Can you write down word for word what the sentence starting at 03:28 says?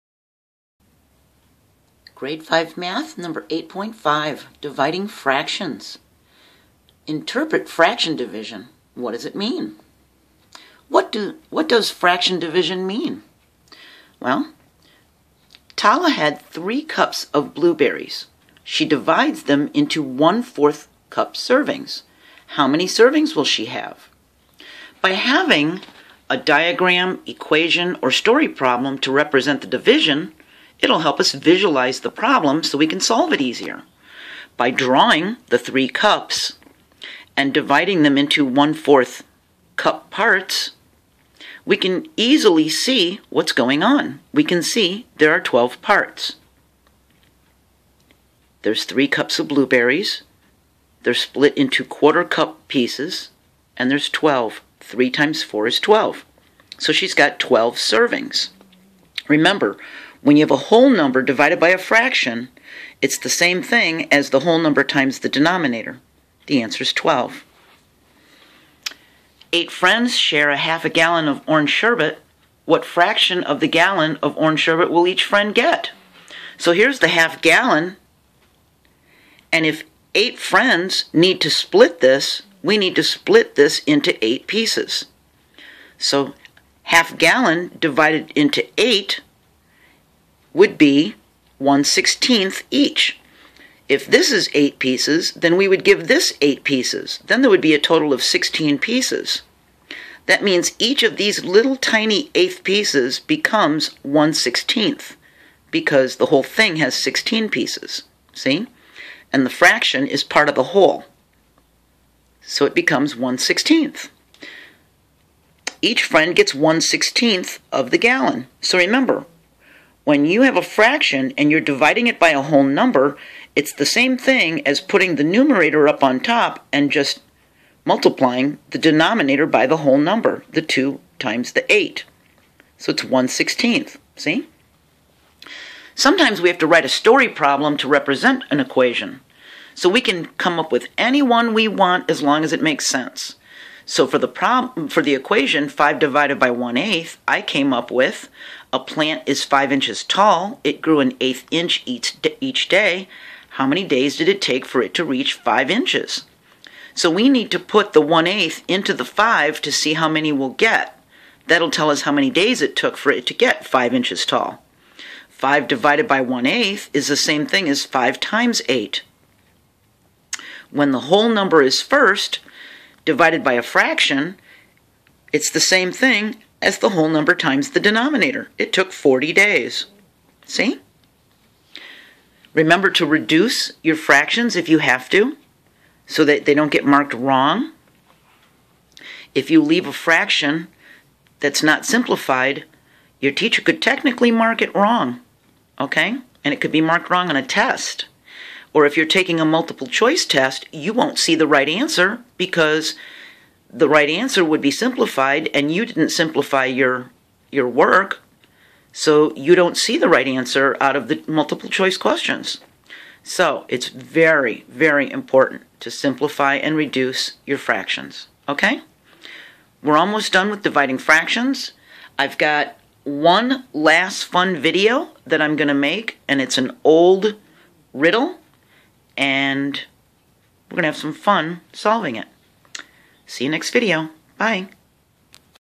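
So you don't see the right answer out of the multiple choice questions.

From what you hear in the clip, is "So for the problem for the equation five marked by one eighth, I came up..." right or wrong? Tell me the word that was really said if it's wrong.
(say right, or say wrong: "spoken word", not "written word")
wrong: "divided", not "marked".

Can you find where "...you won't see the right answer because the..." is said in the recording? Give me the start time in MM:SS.
03:20.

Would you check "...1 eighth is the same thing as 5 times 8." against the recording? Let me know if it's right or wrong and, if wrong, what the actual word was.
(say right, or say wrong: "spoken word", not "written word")
right.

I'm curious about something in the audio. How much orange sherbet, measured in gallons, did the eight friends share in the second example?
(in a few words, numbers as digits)
half a gallon.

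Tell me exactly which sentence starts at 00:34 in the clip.
By drawing the three cups and dividing them into one-fourth cup parts, we can easily see what's going on.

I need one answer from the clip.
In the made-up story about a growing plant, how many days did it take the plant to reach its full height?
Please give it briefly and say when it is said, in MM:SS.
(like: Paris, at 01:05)
40 days, at 02:58.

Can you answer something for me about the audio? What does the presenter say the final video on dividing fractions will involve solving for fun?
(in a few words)
an old riddle.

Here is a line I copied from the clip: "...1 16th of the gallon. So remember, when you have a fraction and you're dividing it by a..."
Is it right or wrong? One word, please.
right.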